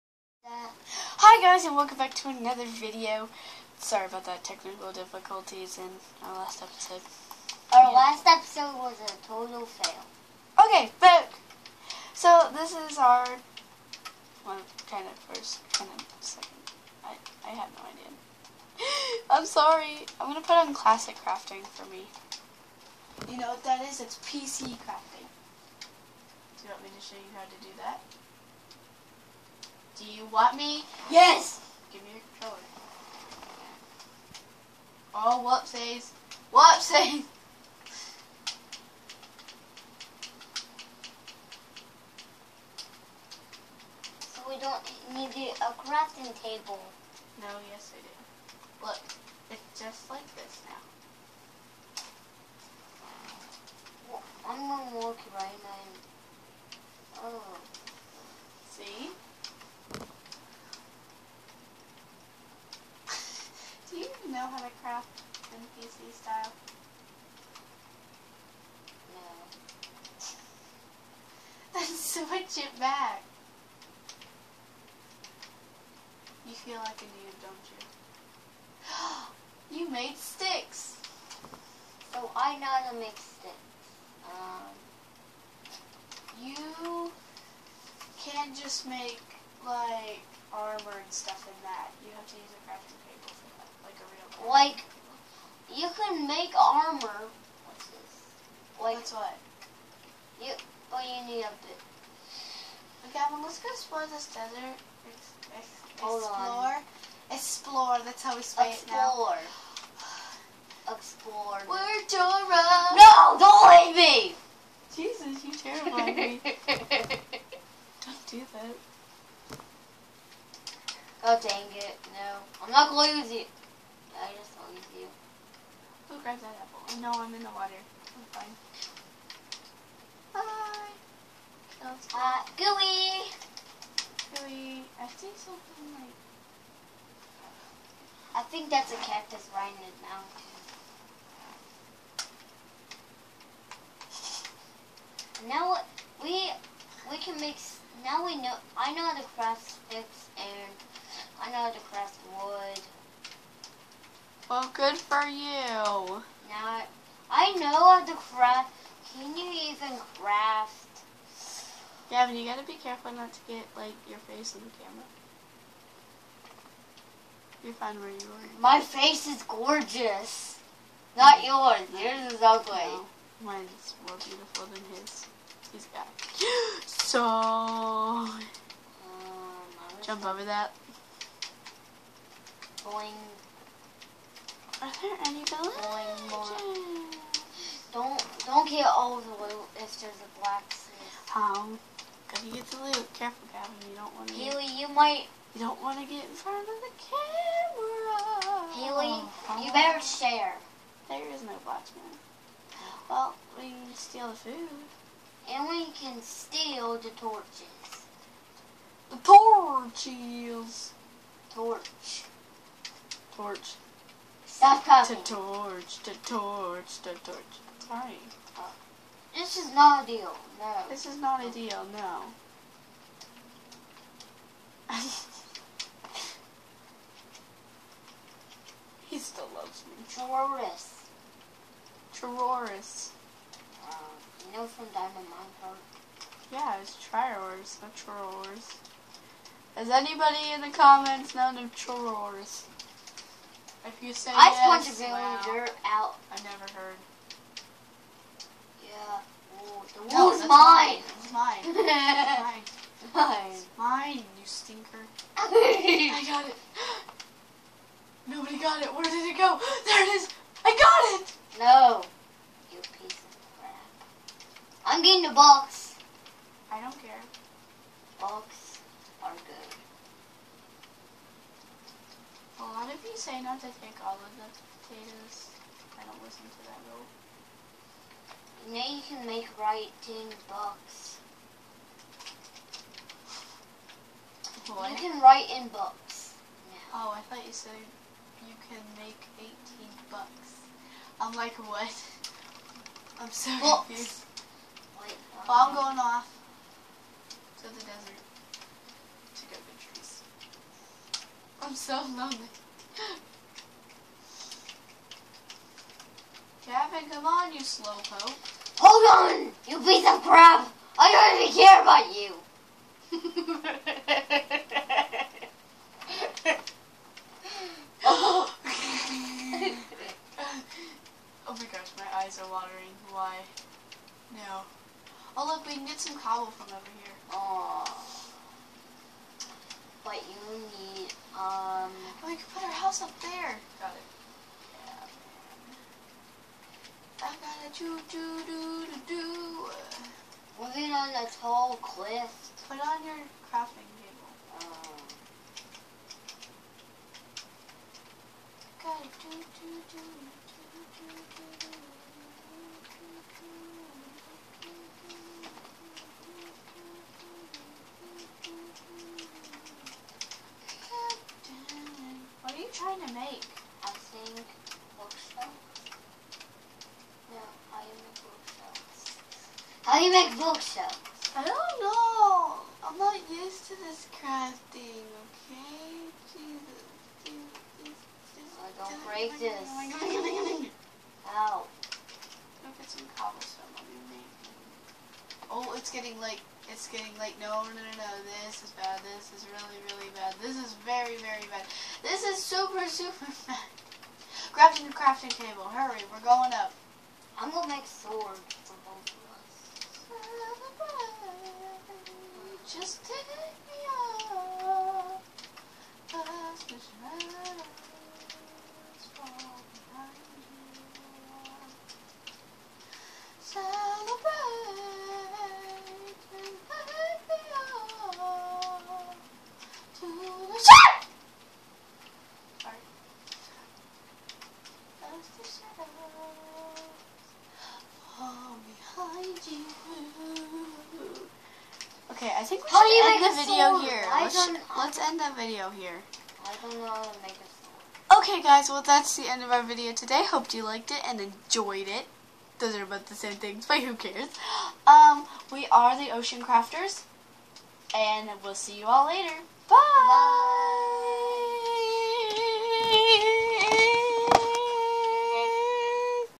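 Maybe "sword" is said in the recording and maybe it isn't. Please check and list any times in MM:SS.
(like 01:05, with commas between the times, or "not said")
06:37, 07:13, 07:18.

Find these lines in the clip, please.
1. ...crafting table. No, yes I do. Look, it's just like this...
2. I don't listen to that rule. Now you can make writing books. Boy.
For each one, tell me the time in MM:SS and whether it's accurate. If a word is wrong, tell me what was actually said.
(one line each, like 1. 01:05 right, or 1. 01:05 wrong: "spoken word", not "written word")
1. 00:45 right
2. 04:35 right.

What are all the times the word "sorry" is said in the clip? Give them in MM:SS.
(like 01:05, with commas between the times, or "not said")
00:03, 00:19, 03:37.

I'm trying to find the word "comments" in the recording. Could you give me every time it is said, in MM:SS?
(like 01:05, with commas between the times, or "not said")
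04:00.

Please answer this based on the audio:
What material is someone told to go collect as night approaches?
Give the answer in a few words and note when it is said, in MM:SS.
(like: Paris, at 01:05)
Cobblestone, at 06:23.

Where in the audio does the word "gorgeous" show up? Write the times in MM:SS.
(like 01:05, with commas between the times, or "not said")
02:49.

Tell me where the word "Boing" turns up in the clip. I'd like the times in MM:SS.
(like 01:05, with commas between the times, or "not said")
03:02.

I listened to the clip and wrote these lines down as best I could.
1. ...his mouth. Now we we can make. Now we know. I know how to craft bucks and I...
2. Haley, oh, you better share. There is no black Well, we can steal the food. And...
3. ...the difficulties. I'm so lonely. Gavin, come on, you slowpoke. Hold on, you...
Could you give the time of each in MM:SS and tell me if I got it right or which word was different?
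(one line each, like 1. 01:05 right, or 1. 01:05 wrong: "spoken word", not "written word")
1. 02:19 wrong: "sticks", not "bucks"
2. 03:18 right
3. 04:59 wrong: "trees", not "difficulties".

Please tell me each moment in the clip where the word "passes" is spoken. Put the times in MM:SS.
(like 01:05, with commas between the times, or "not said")
not said.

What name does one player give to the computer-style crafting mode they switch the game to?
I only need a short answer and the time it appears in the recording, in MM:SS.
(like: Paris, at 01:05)
Classic crafting, at 00:20.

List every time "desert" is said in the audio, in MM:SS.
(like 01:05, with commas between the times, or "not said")
01:44, 04:57.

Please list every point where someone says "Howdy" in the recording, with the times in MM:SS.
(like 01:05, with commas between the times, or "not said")
not said.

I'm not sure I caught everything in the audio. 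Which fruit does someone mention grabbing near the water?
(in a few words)
Apple.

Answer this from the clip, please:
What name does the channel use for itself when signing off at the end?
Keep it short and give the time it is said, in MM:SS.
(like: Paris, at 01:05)
Ocean Crafters, at 07:26.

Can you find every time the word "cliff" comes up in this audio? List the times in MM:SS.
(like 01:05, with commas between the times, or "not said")
05:41.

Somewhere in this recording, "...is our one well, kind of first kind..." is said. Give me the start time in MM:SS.
00:12.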